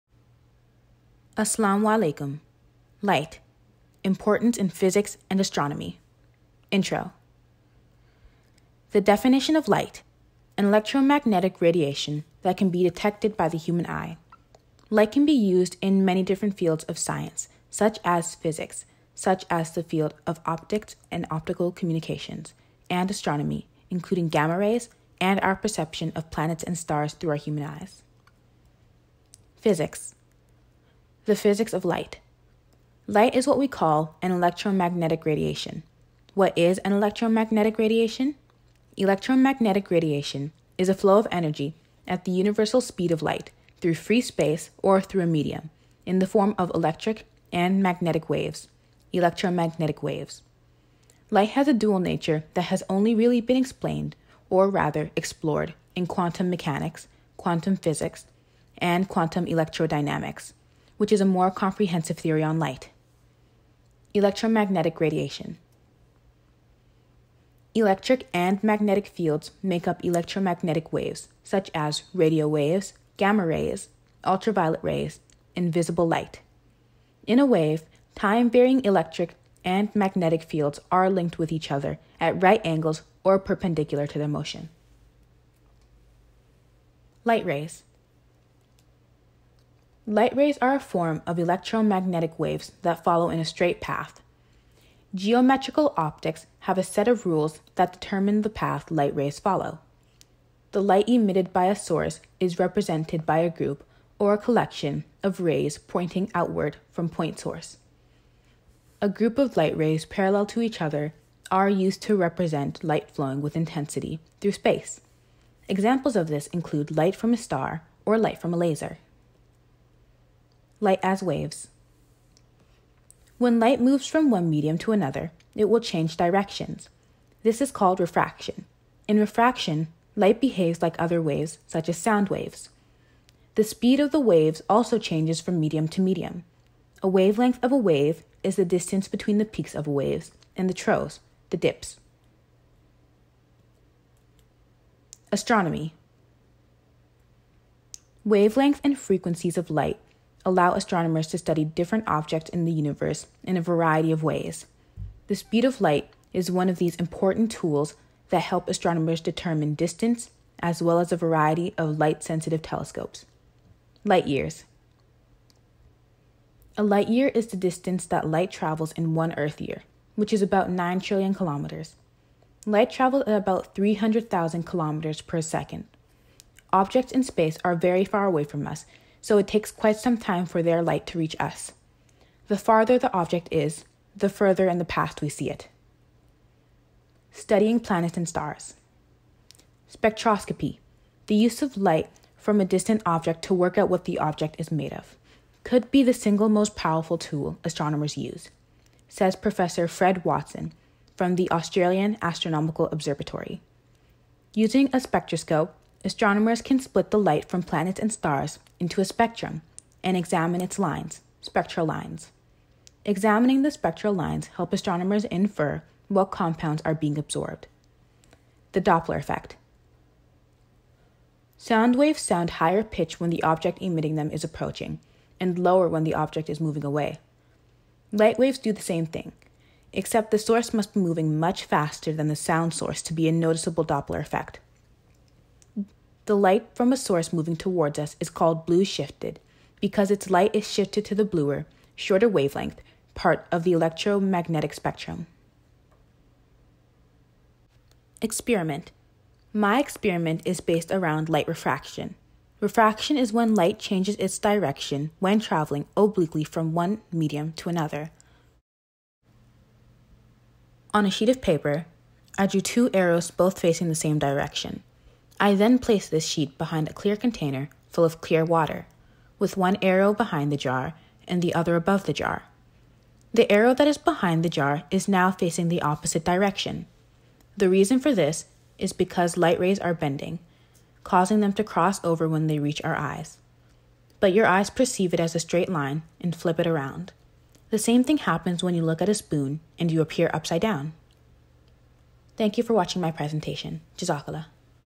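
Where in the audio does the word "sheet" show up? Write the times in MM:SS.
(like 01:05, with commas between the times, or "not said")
04:21, 04:26.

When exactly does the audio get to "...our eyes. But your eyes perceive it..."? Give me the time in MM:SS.
04:42.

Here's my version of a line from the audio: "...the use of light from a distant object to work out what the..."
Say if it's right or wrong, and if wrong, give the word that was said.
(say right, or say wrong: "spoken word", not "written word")
right.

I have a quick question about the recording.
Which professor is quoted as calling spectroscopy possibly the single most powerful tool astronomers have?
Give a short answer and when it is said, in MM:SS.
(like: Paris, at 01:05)
Fred Watson, at 03:19.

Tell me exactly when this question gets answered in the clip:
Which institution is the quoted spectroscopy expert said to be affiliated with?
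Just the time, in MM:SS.
03:21.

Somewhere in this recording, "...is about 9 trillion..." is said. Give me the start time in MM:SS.
02:50.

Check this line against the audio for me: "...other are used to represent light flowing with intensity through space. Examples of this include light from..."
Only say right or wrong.
right.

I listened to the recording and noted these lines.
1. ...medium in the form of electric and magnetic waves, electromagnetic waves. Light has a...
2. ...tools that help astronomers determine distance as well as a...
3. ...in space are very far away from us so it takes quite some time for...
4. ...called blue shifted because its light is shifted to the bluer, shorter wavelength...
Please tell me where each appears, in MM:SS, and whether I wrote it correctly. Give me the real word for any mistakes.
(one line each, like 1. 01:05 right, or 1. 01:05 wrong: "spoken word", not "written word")
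1. 00:45 right
2. 02:37 right
3. 02:57 right
4. 03:58 right.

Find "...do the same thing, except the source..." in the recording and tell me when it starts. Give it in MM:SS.
03:48.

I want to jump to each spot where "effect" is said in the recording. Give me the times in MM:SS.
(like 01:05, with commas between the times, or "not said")
03:39, 03:54.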